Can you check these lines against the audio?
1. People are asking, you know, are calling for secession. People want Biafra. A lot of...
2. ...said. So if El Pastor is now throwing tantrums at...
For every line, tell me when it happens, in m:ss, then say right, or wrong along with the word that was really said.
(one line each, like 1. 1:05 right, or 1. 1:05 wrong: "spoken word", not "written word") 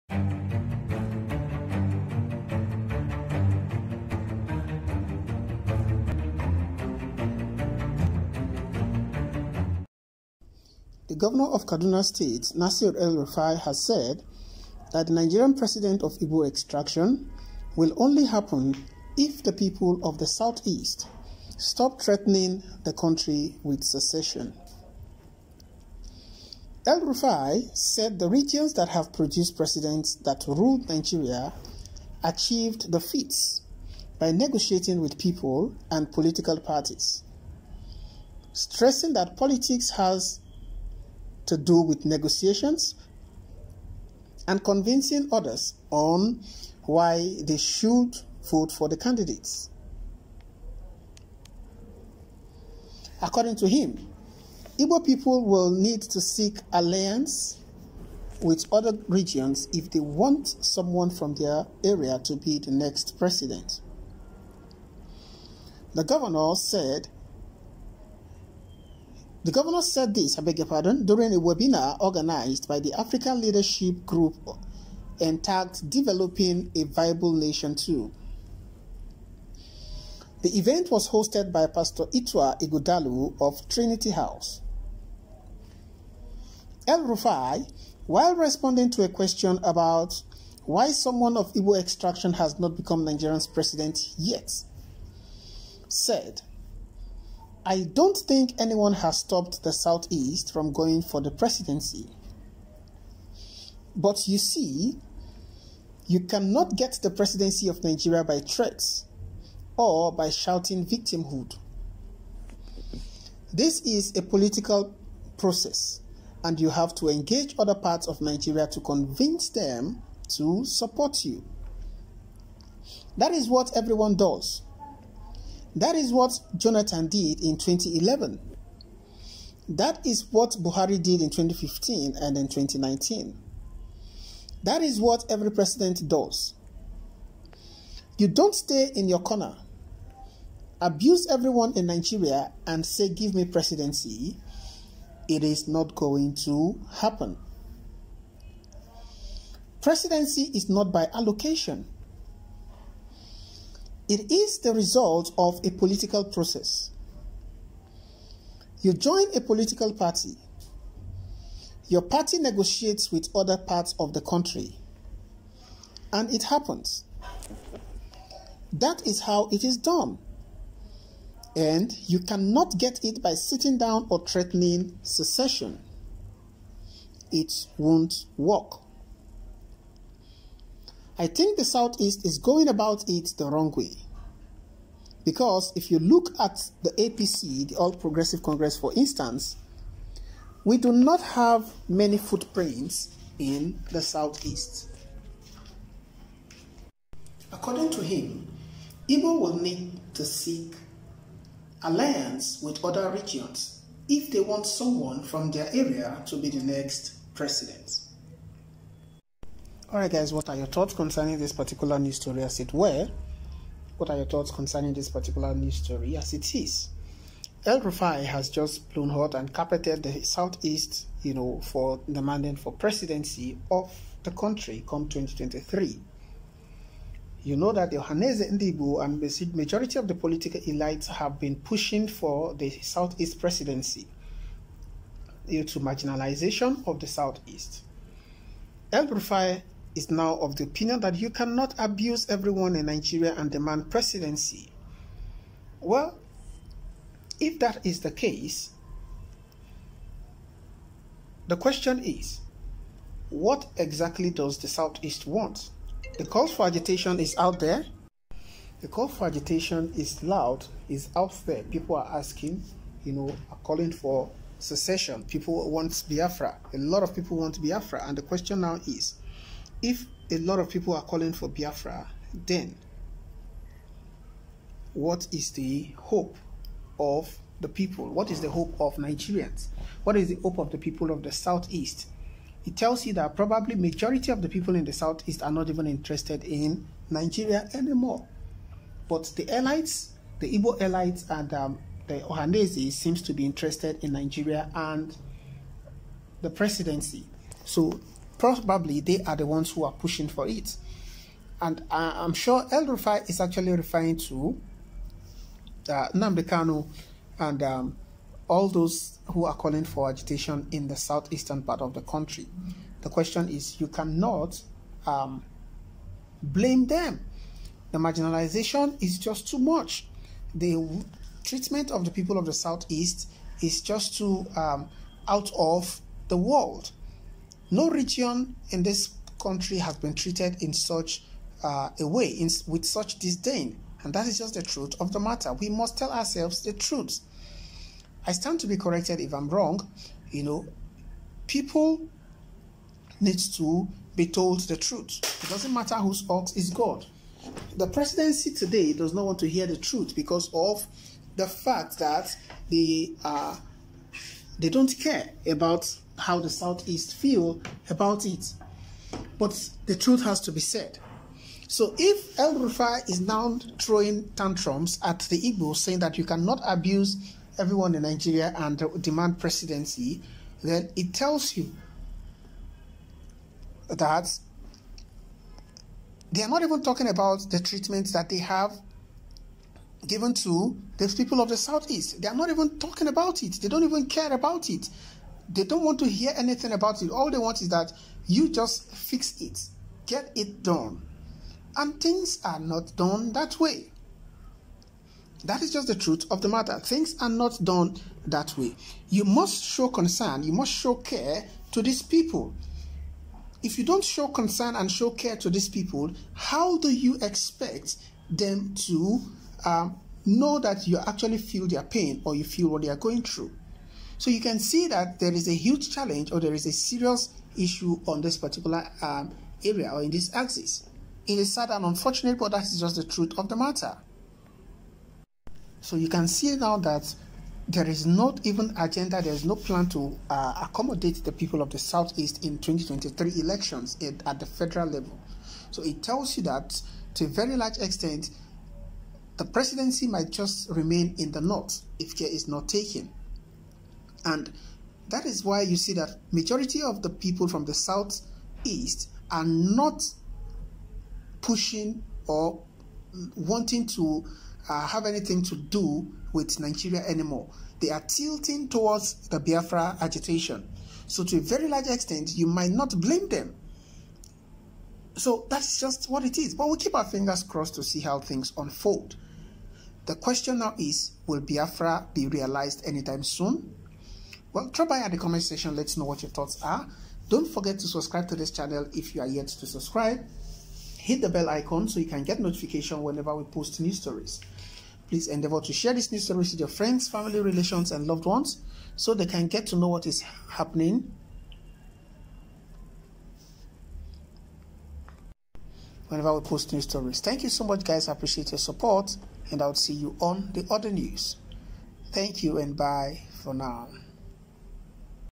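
1. 4:21 right
2. 6:00 wrong: "Rufai", not "Pastor".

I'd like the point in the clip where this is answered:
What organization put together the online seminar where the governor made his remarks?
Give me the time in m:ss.
1:12.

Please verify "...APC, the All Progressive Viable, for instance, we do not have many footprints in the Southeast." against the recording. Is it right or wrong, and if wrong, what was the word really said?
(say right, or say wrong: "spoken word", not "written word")
wrong: "Congress", not "Viable".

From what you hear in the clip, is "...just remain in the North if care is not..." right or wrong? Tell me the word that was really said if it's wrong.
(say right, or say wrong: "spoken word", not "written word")
right.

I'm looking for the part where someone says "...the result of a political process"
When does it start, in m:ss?
2:34.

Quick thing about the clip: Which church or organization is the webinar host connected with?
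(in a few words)
Trinity House.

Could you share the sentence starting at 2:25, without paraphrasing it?
It is not going to happen.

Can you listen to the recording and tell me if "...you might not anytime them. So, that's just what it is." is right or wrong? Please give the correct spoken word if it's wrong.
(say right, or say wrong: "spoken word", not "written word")
wrong: "blame", not "anytime".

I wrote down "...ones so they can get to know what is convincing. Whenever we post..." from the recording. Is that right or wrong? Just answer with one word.
wrong.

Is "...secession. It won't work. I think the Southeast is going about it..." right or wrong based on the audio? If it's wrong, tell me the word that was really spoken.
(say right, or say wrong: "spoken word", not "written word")
right.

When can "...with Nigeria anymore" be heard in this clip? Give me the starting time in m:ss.
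7:36.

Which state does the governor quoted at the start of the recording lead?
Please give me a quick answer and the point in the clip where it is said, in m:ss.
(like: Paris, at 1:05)
Kaduna State, at 0:11.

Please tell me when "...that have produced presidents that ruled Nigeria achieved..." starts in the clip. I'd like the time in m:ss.
0:28.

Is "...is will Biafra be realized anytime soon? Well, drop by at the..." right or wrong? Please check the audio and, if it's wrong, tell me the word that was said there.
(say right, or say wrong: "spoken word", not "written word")
right.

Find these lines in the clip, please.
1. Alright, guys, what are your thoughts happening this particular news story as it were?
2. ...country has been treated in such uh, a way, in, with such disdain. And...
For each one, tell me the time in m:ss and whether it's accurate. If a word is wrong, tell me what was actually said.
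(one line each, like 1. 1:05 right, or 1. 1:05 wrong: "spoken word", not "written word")
1. 3:29 wrong: "concerning", not "happening"
2. 5:29 right.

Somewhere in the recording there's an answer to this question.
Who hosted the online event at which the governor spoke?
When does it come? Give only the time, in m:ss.
1:21.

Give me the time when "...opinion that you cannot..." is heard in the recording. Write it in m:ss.
4:00.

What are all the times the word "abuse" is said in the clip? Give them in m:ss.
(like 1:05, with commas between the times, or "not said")
2:20, 4:01, 6:06.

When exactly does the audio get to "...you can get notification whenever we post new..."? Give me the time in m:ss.
8:02.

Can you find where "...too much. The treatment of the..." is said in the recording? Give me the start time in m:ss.
5:19.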